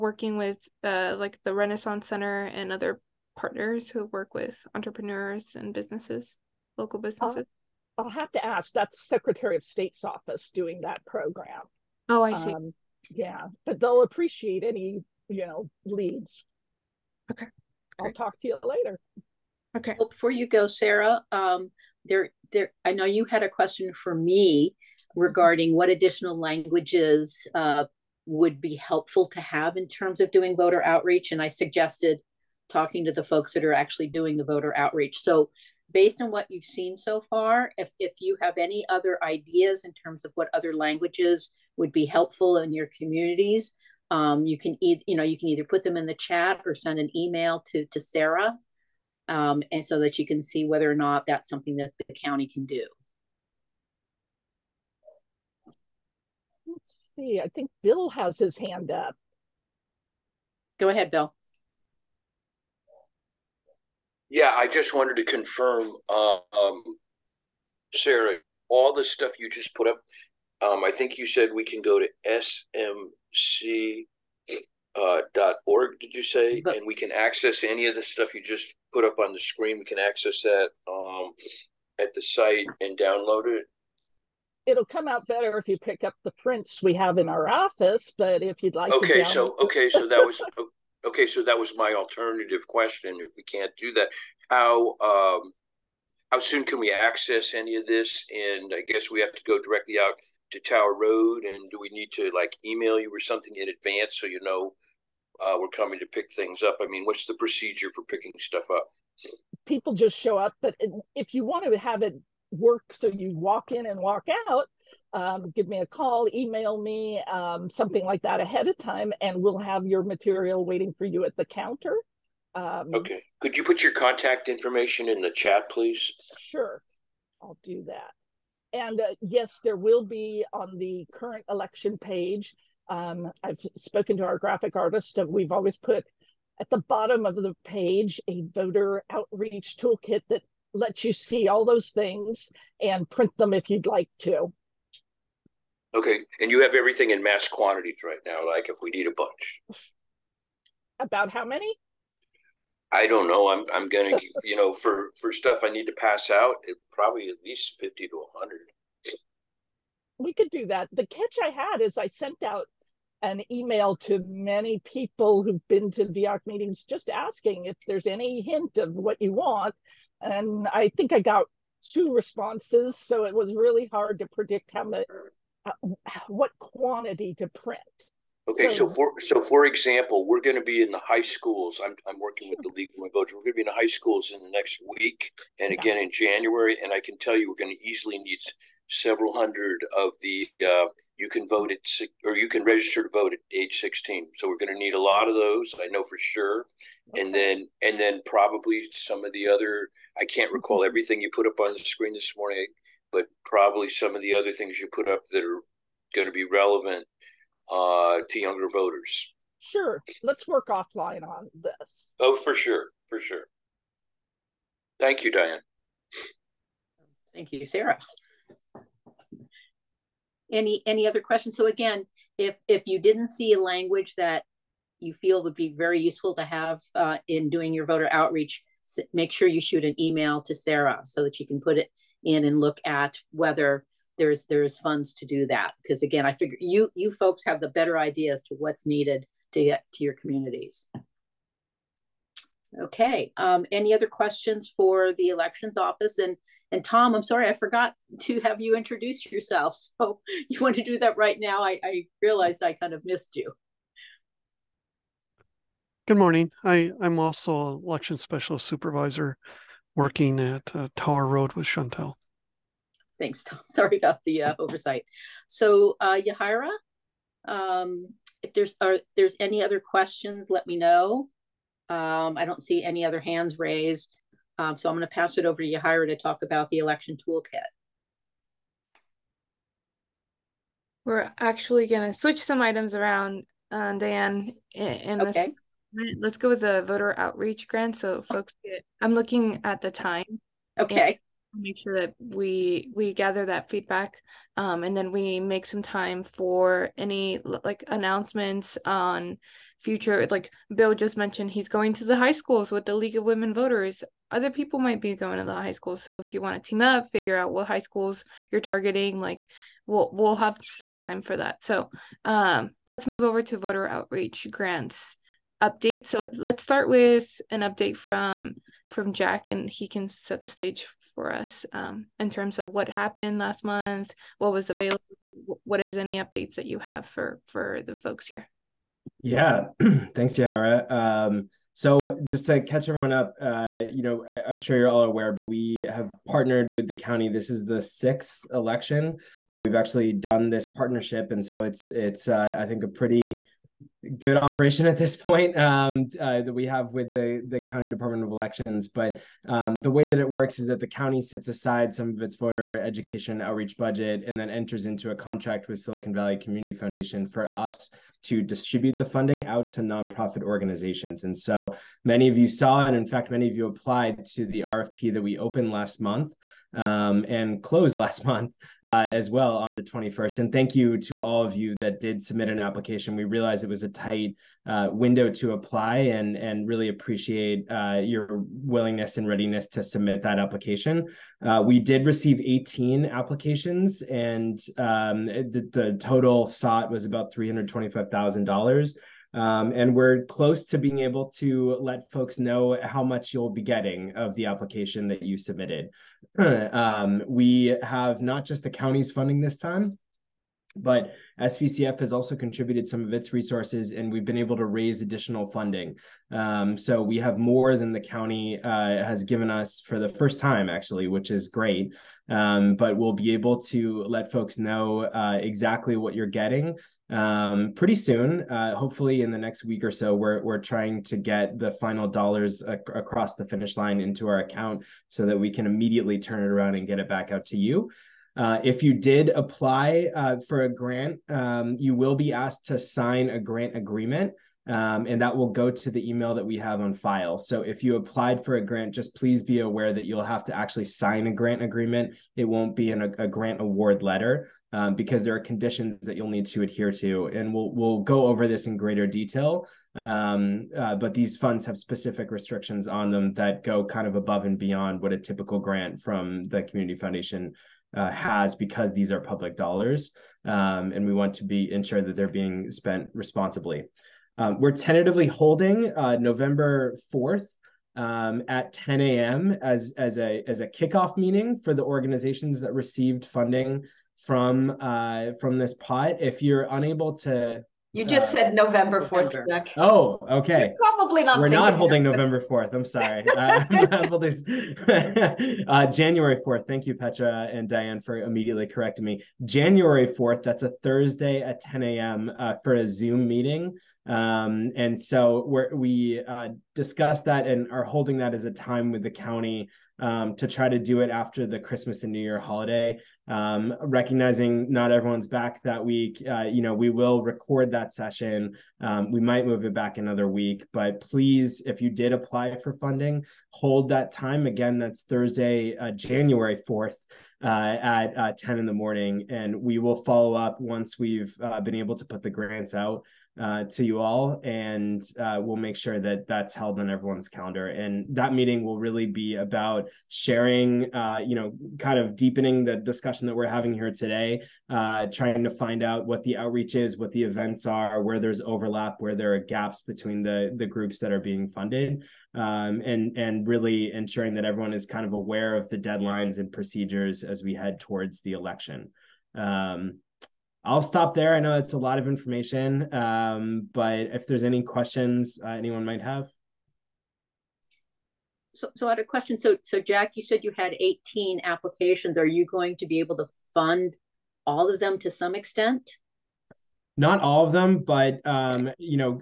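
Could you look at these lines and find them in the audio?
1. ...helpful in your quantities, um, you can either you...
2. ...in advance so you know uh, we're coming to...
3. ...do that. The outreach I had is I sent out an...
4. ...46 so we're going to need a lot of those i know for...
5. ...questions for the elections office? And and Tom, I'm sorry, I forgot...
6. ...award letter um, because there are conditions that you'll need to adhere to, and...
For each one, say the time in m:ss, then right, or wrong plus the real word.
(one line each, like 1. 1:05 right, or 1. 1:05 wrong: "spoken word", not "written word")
1. 0:42 wrong: "communities", not "quantities"
2. 1:43 right
3. 2:40 wrong: "catch", not "outreach"
4. 3:13 wrong: "16", not "46"
5. 4:04 right
6. 7:23 right.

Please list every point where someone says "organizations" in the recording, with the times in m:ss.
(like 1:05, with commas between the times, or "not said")
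6:00, 7:51.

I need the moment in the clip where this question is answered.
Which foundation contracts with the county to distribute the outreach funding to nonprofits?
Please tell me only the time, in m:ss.
5:55.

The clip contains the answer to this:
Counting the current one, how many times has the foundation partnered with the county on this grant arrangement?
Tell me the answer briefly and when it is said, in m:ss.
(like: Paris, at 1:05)
sixth, at 5:37.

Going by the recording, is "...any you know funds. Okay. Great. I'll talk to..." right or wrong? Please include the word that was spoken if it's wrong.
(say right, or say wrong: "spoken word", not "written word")
wrong: "leads", not "funds".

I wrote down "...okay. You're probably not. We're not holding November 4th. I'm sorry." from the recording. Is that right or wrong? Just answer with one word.
right.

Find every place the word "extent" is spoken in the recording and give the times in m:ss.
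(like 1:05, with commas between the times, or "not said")
9:25.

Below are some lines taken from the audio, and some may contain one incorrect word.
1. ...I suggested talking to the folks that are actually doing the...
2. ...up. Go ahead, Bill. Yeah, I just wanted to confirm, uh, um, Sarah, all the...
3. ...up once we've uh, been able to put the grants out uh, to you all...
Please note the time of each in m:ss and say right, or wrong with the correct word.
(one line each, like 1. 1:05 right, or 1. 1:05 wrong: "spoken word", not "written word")
1. 0:31 right
2. 0:58 right
3. 8:40 right.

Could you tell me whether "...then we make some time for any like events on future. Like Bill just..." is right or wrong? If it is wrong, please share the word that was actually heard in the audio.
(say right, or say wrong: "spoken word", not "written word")
wrong: "announcements", not "events".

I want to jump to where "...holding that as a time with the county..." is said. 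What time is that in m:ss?
8:17.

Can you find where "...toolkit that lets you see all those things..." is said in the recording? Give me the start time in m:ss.
2:19.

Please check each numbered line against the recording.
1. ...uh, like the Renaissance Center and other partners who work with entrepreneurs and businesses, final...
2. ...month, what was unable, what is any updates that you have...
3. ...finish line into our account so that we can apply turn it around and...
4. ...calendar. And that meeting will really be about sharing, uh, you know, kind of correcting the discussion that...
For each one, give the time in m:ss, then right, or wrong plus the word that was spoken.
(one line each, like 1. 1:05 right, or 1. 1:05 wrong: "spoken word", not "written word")
1. 0:00 wrong: "local", not "final"
2. 5:23 wrong: "available", not "unable"
3. 7:03 wrong: "immediately", not "apply"
4. 8:47 wrong: "deepening", not "correcting".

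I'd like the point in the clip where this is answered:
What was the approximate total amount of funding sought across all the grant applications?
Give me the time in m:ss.
6:27.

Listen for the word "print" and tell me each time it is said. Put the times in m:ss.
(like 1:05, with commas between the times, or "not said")
1:26, 2:23, 2:57.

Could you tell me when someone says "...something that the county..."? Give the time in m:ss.
0:51.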